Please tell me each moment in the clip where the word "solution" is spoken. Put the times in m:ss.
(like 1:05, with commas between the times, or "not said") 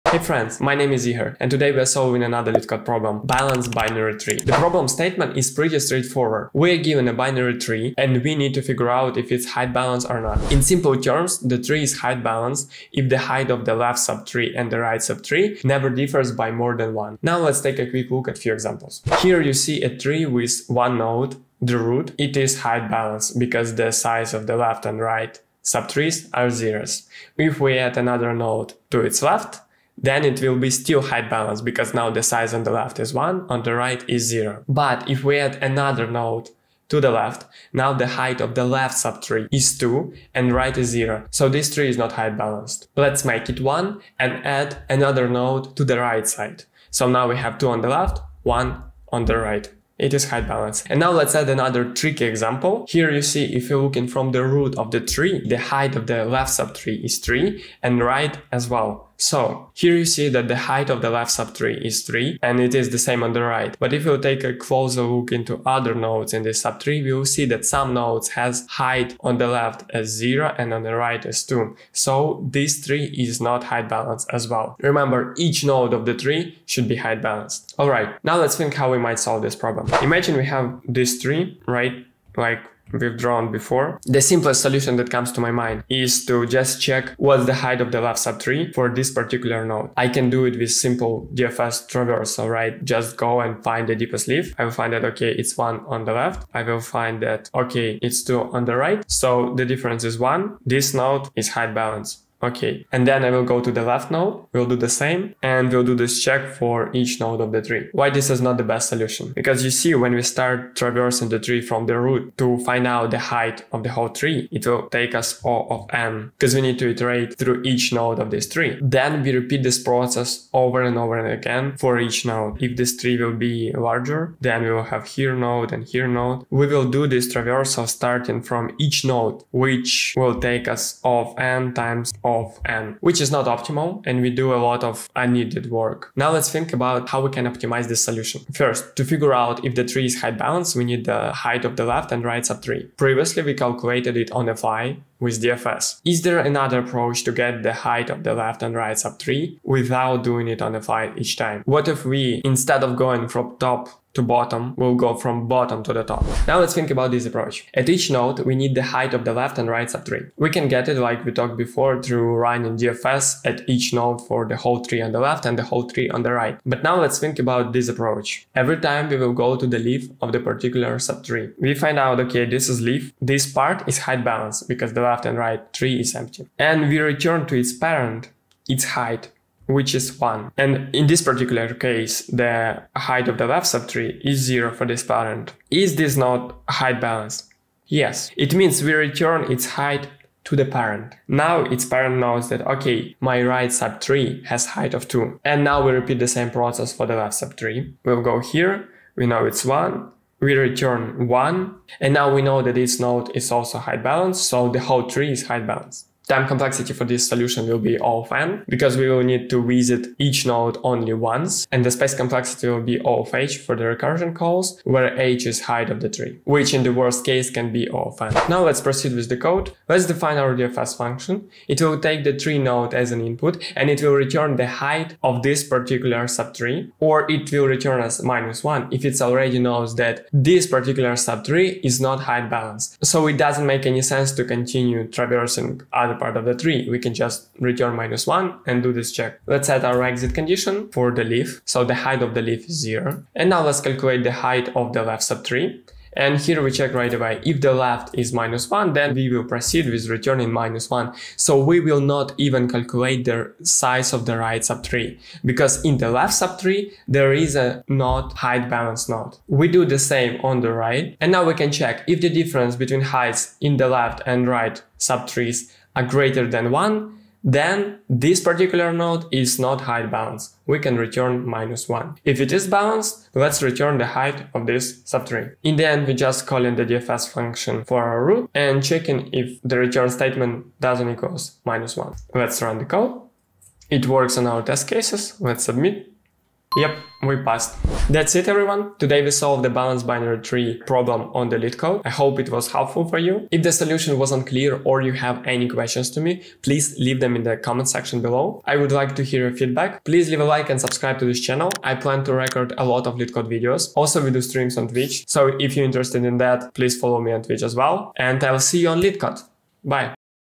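1:24, 1:48, 2:18, 3:27, 4:53.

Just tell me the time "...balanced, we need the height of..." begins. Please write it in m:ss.
2:20.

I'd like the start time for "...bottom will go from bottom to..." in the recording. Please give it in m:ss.
2:34.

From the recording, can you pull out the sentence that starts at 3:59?
Let's set our exit condition for the leaf.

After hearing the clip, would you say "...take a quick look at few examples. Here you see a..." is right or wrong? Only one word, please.
right.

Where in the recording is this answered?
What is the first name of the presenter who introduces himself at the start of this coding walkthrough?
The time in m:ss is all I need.
0:01.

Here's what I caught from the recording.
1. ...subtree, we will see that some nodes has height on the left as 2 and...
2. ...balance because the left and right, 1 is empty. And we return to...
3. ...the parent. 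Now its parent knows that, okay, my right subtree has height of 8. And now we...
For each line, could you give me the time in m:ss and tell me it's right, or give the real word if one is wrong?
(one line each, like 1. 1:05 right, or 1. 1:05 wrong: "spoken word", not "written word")
1. 1:06 wrong: "0", not "2"
2. 2:54 wrong: "3", not "1"
3. 3:10 wrong: "2", not "8".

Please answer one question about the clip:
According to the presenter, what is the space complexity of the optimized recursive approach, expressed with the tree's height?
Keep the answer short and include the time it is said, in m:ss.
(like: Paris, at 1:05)
O of h, at 3:33.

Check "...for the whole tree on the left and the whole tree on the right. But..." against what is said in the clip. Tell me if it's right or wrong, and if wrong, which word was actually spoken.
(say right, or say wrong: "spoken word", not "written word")
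right.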